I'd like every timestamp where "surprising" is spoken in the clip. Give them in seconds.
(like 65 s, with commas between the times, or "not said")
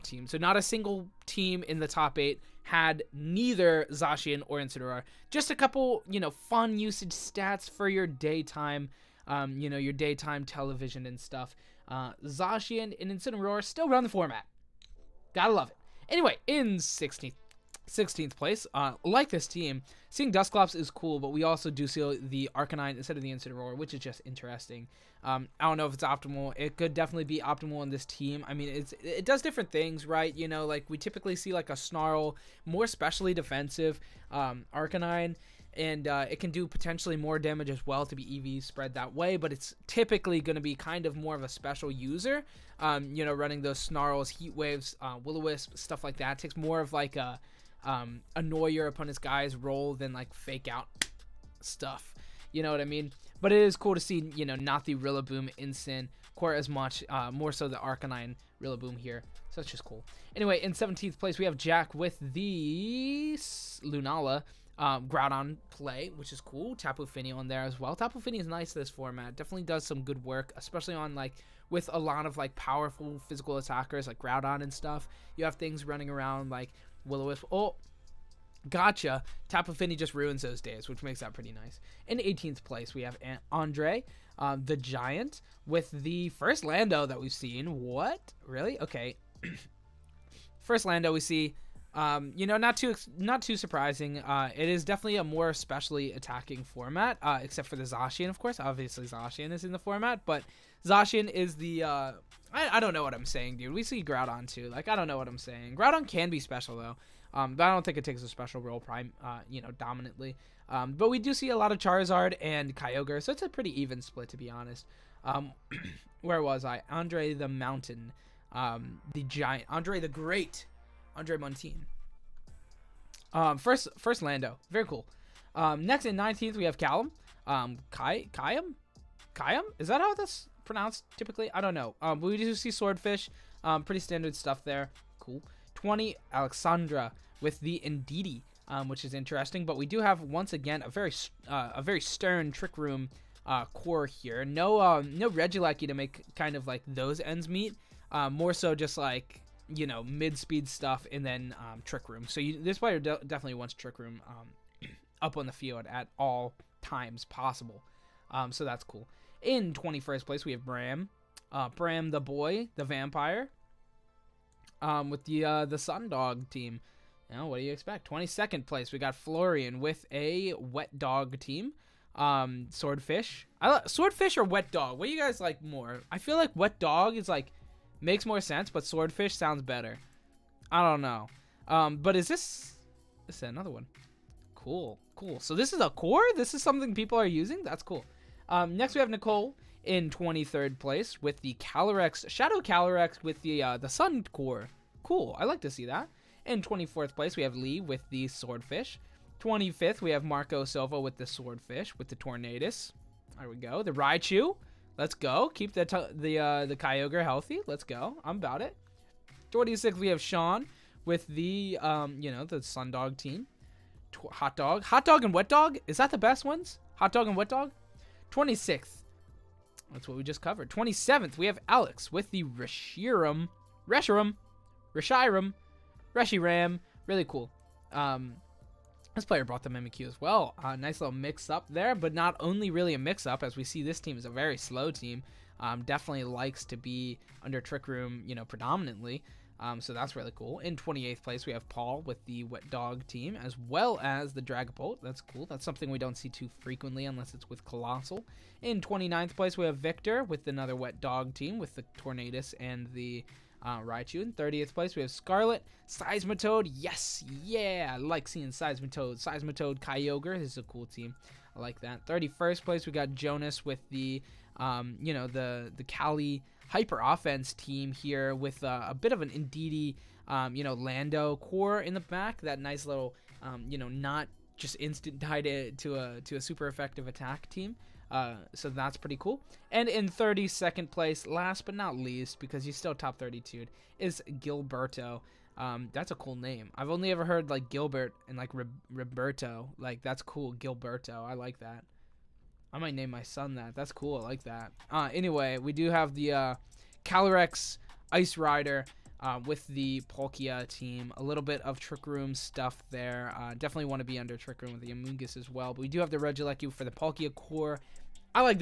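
93 s.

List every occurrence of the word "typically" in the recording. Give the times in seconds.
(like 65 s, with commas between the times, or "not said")
30 s, 39 s, 131 s.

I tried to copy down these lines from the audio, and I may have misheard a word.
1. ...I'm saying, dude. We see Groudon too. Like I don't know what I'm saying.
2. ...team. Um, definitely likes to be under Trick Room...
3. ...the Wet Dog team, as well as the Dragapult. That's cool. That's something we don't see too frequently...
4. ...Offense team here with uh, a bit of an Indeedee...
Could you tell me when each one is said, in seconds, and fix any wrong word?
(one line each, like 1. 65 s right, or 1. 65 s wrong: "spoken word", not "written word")
1. 103 s right
2. 234 s right
3. 242 s right
4. 267 s right.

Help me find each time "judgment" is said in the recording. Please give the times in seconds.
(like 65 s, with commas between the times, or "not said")
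not said.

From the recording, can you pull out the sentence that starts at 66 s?
Tapu Fini on there as well.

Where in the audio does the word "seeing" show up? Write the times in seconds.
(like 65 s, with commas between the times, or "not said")
20 s, 258 s.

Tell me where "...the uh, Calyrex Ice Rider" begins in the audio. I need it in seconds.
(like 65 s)
296 s.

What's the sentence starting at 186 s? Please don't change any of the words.
This is something people are using?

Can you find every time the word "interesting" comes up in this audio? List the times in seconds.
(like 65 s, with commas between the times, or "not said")
24 s, 139 s.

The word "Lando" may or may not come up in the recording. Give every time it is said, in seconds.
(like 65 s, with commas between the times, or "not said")
86 s, 90 s, 124 s, 270 s.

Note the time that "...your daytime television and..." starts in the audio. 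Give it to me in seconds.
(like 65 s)
9 s.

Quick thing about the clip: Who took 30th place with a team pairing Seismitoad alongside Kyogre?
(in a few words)
Scarlet.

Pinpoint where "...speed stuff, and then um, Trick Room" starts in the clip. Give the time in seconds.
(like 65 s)
150 s.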